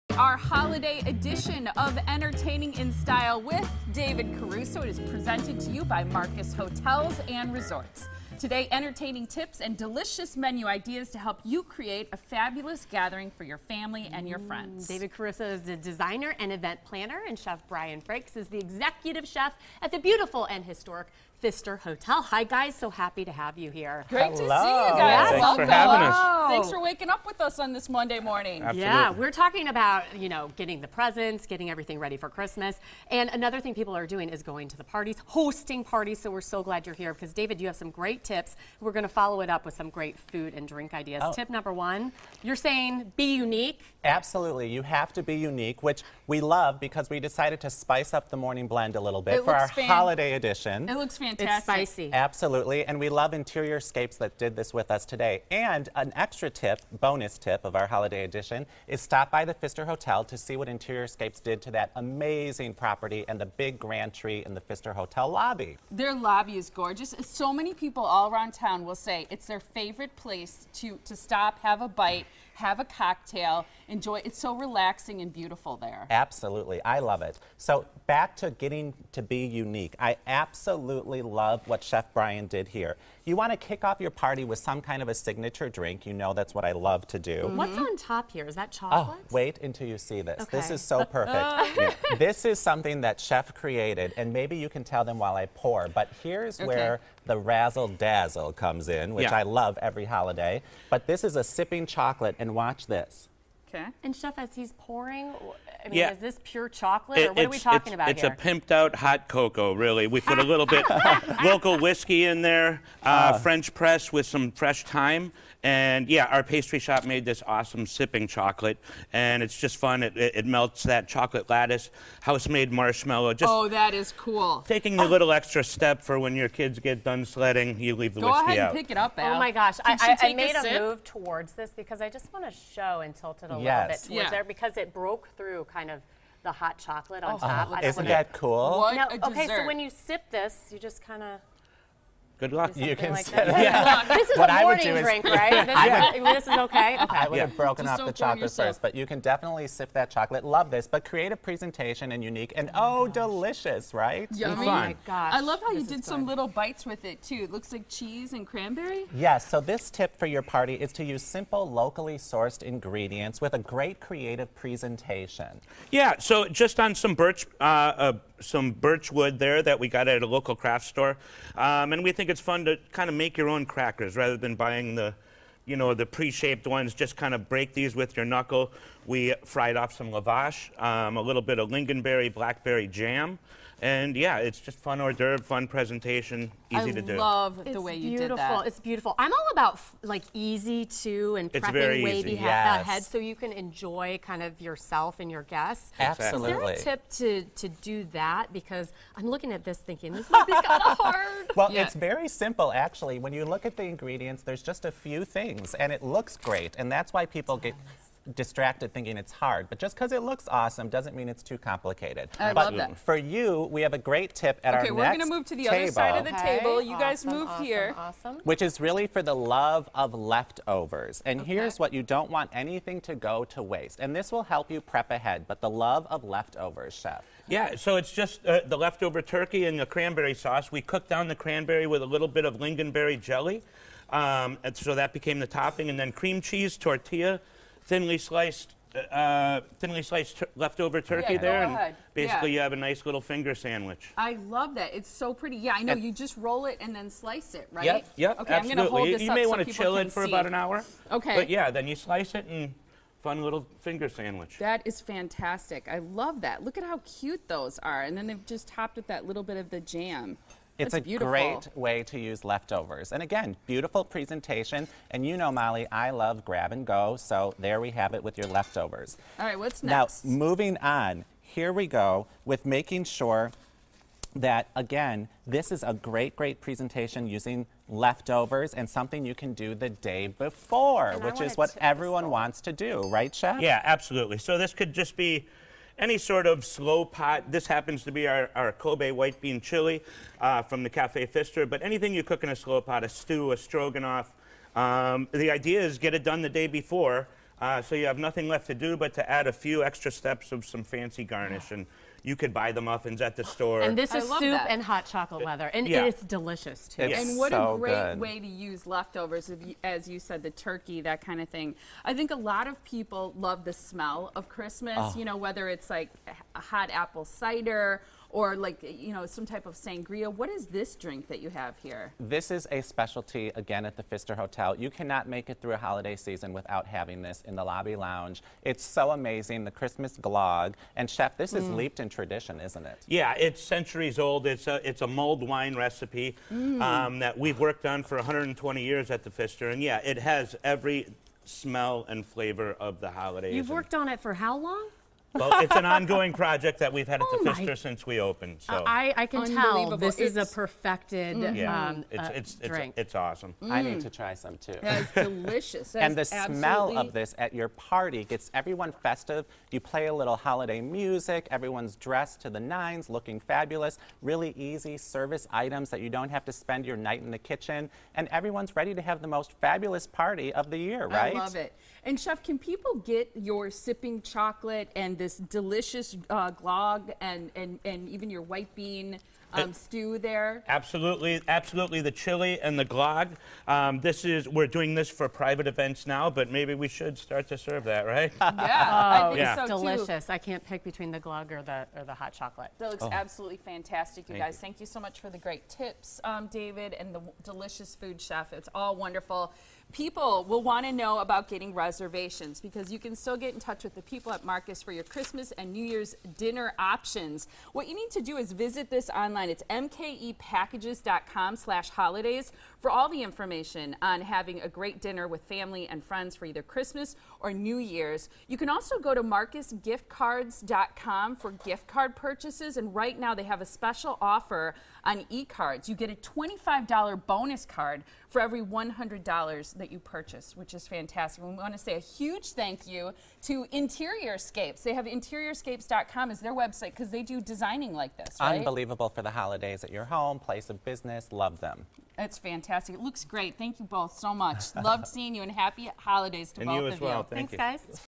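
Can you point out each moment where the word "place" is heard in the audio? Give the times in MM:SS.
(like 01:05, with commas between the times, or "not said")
01:10, 07:20.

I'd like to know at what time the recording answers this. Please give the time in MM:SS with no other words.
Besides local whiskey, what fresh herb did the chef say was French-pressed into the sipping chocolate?
01:54.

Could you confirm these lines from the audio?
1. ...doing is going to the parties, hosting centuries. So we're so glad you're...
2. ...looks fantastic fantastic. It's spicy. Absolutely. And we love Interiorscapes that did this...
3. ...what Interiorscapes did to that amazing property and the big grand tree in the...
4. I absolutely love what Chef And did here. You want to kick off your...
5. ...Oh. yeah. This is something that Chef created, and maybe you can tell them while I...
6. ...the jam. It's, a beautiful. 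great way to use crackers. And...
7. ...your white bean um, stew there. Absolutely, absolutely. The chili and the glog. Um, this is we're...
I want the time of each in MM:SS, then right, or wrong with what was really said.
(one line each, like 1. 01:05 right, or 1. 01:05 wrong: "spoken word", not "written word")
1. 00:34 wrong: "parties", not "centuries"
2. 00:50 right
3. 01:00 right
4. 01:19 wrong: "Brian", not "And"
5. 01:31 right
6. 04:19 wrong: "leftovers", not "crackers"
7. 06:18 right.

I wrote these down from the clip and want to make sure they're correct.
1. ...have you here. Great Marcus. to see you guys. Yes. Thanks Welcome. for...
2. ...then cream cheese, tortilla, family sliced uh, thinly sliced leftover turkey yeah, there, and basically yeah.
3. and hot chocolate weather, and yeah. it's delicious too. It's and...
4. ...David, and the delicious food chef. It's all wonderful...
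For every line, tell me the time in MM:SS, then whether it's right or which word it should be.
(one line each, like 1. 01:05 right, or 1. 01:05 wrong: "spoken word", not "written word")
1. 00:23 wrong: "Hello", not "Marcus"
2. 03:55 wrong: "thinly", not "family"
3. 05:04 right
4. 06:36 right.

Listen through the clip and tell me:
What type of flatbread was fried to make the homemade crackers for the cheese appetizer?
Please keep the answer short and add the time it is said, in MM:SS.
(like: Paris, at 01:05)
lavash, at 03:00.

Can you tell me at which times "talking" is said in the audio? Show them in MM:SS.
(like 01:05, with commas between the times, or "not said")
00:29, 01:47.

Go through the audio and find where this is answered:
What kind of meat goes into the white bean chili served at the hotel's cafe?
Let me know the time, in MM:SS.
04:48.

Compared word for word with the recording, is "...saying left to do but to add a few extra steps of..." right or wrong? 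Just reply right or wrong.
wrong.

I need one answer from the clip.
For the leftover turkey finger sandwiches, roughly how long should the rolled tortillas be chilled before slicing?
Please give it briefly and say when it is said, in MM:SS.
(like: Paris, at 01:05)
about an hour, at 04:10.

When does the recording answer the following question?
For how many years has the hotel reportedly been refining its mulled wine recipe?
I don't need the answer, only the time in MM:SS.
05:38.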